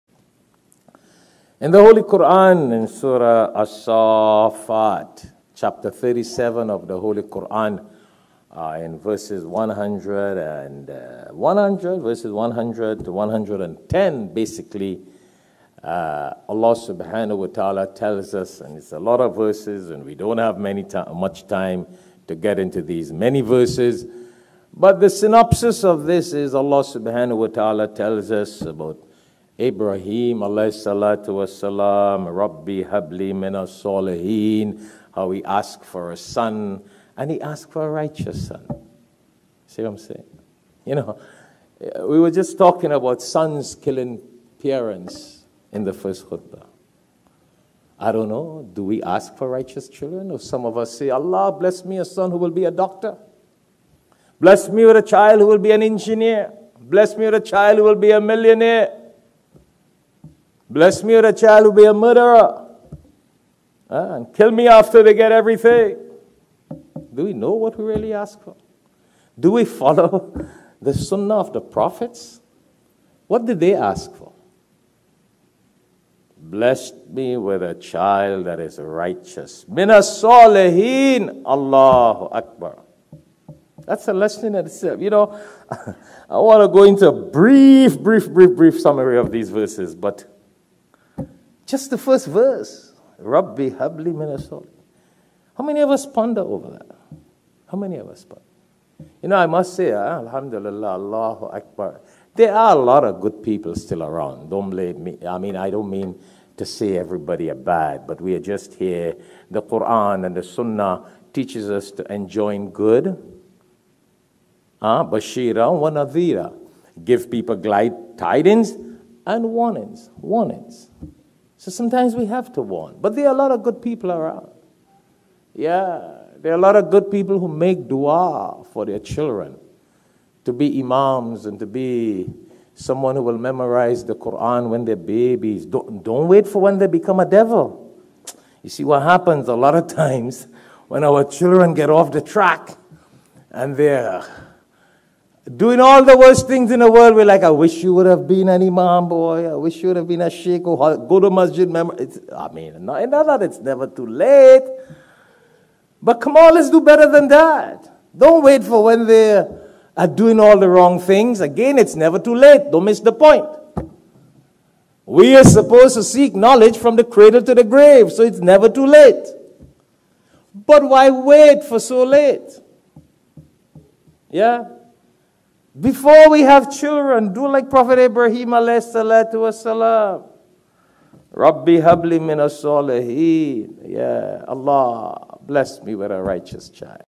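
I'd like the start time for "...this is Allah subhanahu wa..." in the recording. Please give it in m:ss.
0:26.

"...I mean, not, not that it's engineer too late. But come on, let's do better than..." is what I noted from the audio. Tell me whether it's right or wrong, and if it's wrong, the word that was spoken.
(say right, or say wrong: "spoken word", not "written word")
wrong: "never", not "engineer".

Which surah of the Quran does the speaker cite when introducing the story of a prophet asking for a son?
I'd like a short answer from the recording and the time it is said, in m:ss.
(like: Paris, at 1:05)
As-Safat, at 0:03.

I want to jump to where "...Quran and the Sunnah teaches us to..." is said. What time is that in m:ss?
1:49.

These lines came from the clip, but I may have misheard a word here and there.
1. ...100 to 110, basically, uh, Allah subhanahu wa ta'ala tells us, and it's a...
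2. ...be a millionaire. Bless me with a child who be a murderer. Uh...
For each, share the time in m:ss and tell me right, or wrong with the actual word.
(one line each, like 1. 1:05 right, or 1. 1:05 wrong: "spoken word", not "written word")
1. 0:12 right
2. 0:57 right.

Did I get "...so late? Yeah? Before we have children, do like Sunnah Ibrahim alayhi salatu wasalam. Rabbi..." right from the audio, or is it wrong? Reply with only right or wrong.
wrong.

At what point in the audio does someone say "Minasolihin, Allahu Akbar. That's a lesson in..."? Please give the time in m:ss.
1:19.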